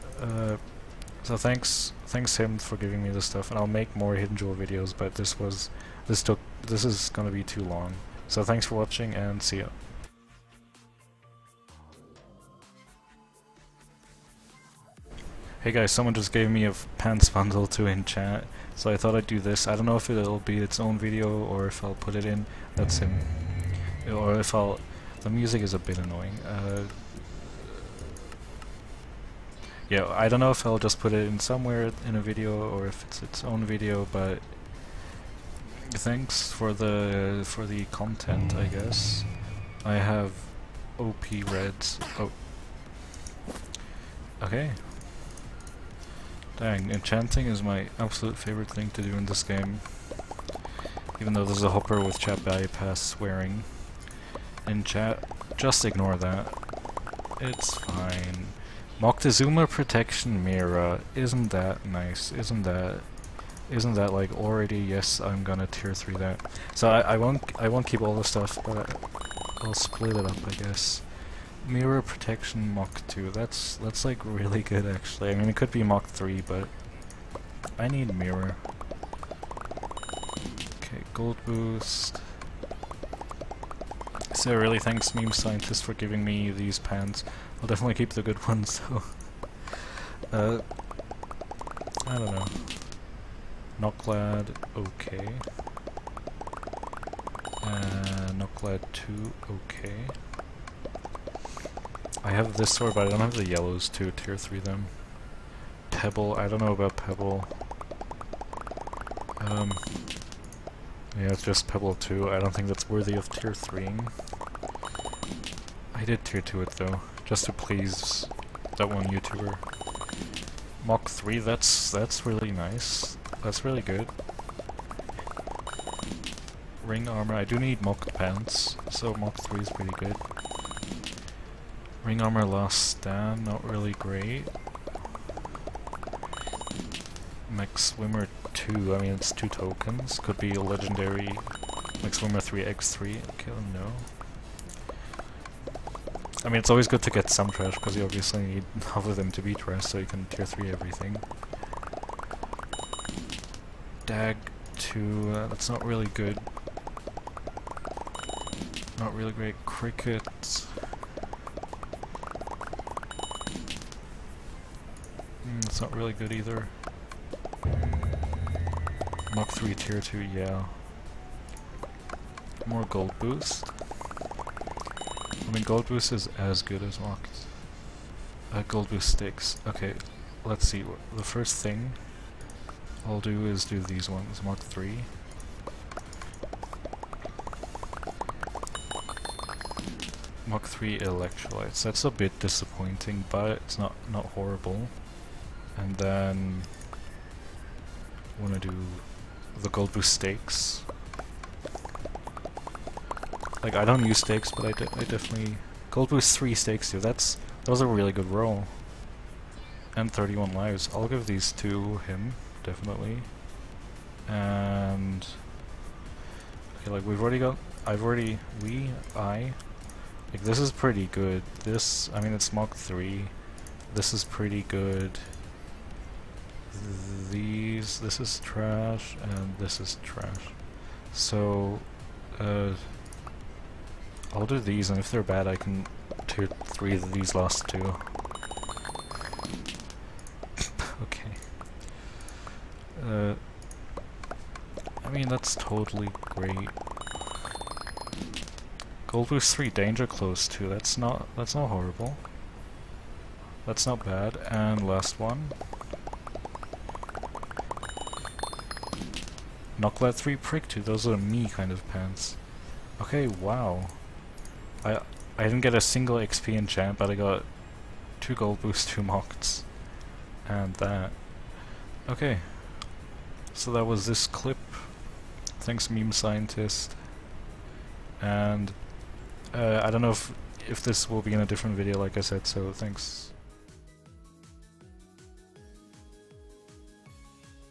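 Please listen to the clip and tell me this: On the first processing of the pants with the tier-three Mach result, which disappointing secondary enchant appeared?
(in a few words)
Electrolytes.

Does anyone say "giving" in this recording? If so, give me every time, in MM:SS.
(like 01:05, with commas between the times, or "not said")
00:02, 01:25.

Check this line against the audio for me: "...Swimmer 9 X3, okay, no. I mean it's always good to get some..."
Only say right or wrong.
wrong.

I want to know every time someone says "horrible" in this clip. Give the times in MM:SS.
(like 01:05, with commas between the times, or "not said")
03:14, 04:11.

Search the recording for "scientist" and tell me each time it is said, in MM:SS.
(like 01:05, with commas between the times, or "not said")
01:25, 04:36.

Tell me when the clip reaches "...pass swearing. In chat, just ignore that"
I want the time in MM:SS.
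00:52.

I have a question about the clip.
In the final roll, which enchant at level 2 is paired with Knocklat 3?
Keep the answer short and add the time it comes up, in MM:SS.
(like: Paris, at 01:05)
Prick, at 04:20.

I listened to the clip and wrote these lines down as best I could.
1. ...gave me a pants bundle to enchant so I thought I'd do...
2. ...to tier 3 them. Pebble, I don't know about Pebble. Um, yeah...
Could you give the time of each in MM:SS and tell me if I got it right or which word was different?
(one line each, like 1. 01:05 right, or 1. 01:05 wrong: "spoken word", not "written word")
1. 00:16 right
2. 01:43 right.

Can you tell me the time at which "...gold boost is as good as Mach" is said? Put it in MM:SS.
02:55.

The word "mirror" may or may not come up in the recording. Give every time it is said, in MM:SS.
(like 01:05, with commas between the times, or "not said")
01:00, 01:11, 01:18.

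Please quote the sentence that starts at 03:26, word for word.
That's, that was a really good roll.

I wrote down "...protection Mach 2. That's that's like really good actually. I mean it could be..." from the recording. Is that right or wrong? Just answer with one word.
right.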